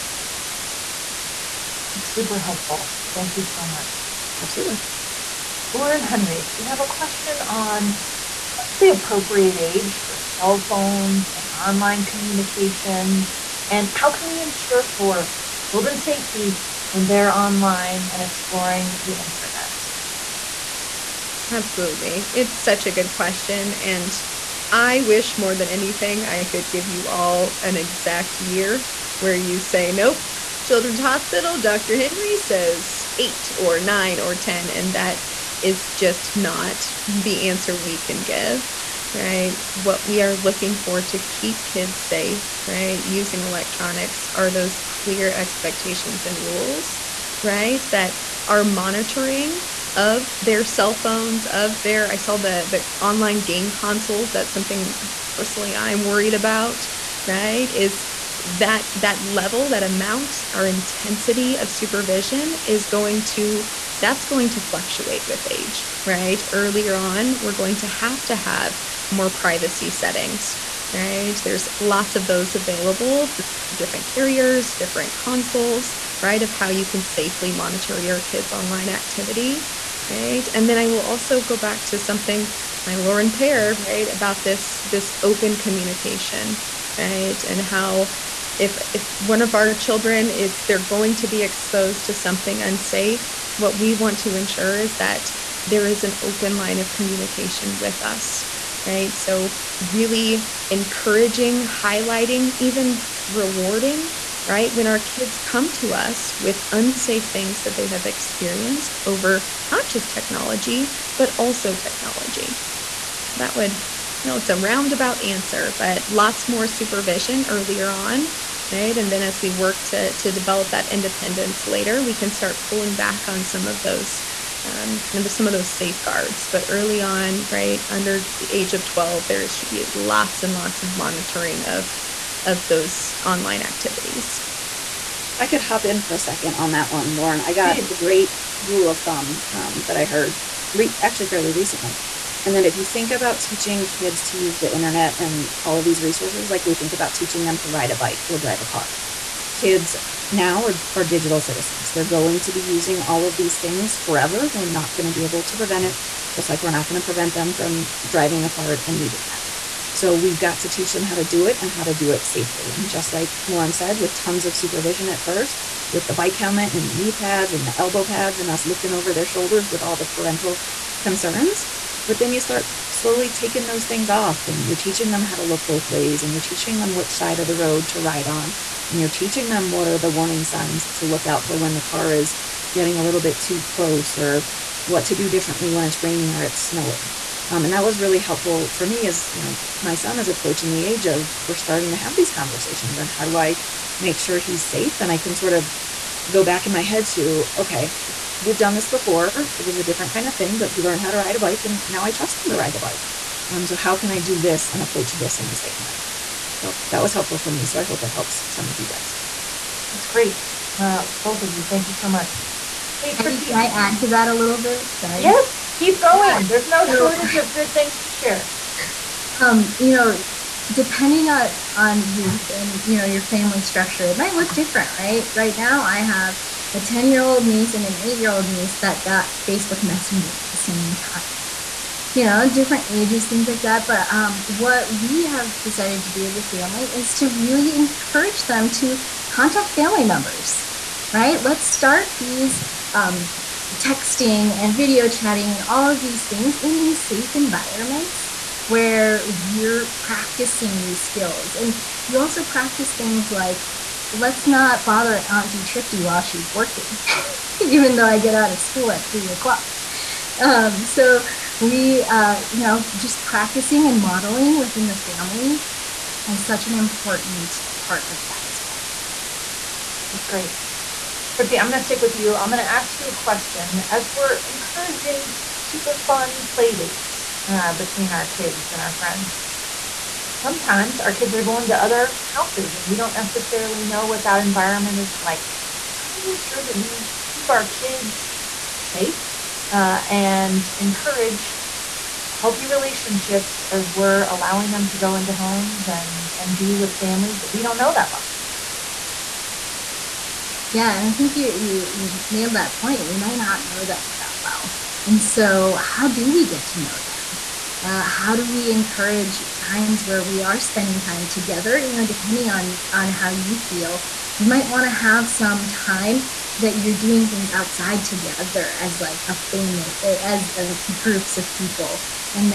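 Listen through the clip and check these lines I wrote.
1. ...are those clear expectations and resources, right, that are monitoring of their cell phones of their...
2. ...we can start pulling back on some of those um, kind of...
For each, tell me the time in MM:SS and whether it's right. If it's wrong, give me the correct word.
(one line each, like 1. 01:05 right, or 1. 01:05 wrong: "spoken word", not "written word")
1. 00:44 wrong: "rules", not "resources"
2. 02:02 right.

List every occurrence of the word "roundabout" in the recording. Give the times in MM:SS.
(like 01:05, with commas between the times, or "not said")
01:54.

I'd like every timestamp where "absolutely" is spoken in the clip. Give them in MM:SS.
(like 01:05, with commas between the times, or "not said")
00:04, 00:21.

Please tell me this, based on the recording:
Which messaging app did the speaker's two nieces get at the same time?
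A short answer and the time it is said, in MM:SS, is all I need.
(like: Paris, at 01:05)
Facebook Messenger, at 03:49.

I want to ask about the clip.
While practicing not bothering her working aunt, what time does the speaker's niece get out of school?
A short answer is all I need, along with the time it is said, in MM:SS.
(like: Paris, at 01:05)
3 o'clock, at 04:19.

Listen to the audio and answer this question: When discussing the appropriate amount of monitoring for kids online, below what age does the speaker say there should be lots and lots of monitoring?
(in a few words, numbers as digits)
12.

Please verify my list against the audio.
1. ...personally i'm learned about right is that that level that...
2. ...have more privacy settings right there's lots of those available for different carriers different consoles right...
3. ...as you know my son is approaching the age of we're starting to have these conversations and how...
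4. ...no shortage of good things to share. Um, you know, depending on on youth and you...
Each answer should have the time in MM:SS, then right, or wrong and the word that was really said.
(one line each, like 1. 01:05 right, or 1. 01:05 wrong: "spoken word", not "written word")
1. 00:55 wrong: "worried", not "learned"
2. 01:08 right
3. 03:09 right
4. 03:36 right.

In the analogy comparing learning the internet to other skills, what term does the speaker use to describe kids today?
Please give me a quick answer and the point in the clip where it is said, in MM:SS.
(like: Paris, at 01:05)
Digital citizens, at 02:31.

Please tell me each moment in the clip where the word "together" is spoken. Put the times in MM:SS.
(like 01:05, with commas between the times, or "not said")
05:11, 05:18.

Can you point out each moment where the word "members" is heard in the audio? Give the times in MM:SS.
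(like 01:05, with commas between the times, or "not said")
04:00.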